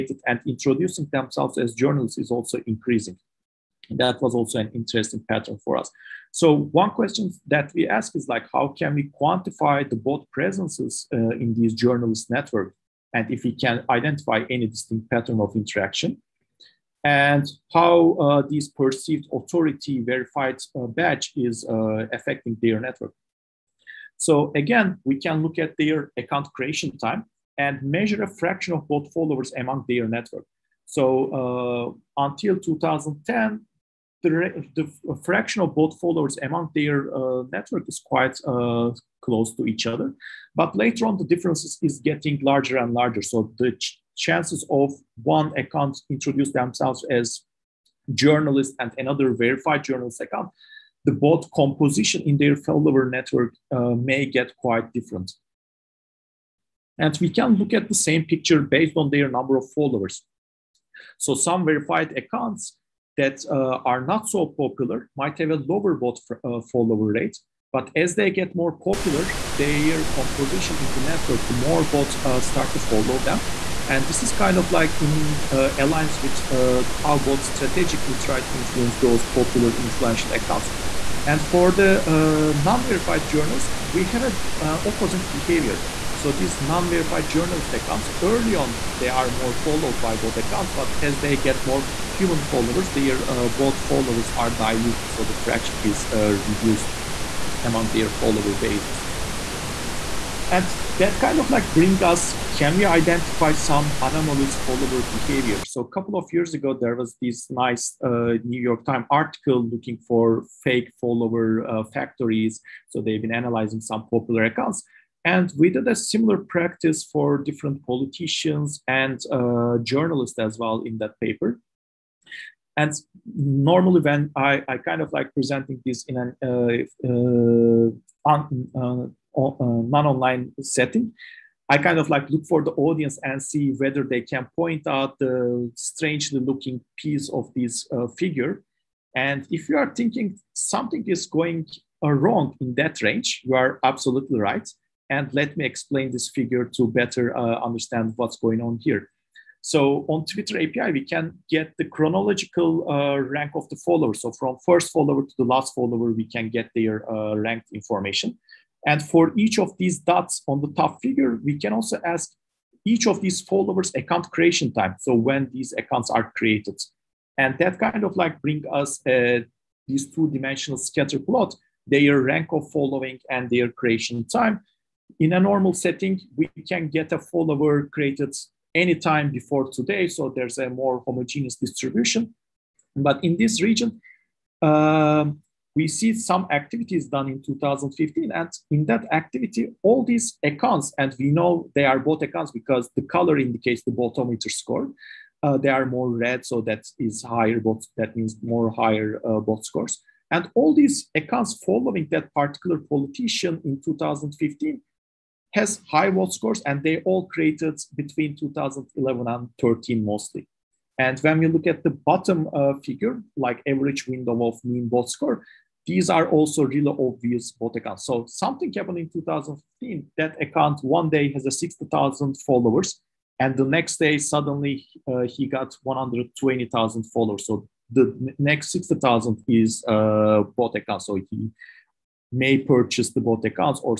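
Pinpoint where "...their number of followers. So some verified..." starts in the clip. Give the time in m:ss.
0:59.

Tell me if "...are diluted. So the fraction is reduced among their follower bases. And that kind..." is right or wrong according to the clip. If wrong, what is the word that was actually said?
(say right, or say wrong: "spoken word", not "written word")
right.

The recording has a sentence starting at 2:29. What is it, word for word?
So on Twitter API, we can get the chronological uh, rank of the follower.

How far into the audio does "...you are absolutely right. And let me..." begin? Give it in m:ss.
2:23.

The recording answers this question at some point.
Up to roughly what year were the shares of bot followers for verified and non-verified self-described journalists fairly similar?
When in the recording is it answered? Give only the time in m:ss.
0:32.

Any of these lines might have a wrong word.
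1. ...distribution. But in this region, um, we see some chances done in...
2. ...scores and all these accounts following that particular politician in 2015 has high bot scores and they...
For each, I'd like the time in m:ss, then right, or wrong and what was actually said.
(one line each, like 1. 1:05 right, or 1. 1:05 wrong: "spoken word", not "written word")
1. 3:01 wrong: "activities", not "chances"
2. 3:19 right.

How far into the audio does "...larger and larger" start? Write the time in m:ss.
0:42.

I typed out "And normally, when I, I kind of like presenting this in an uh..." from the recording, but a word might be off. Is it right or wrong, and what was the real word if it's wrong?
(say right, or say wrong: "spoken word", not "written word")
right.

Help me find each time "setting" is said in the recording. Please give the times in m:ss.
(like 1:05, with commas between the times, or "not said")
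2:10, 2:55.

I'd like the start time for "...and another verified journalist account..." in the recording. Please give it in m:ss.
0:48.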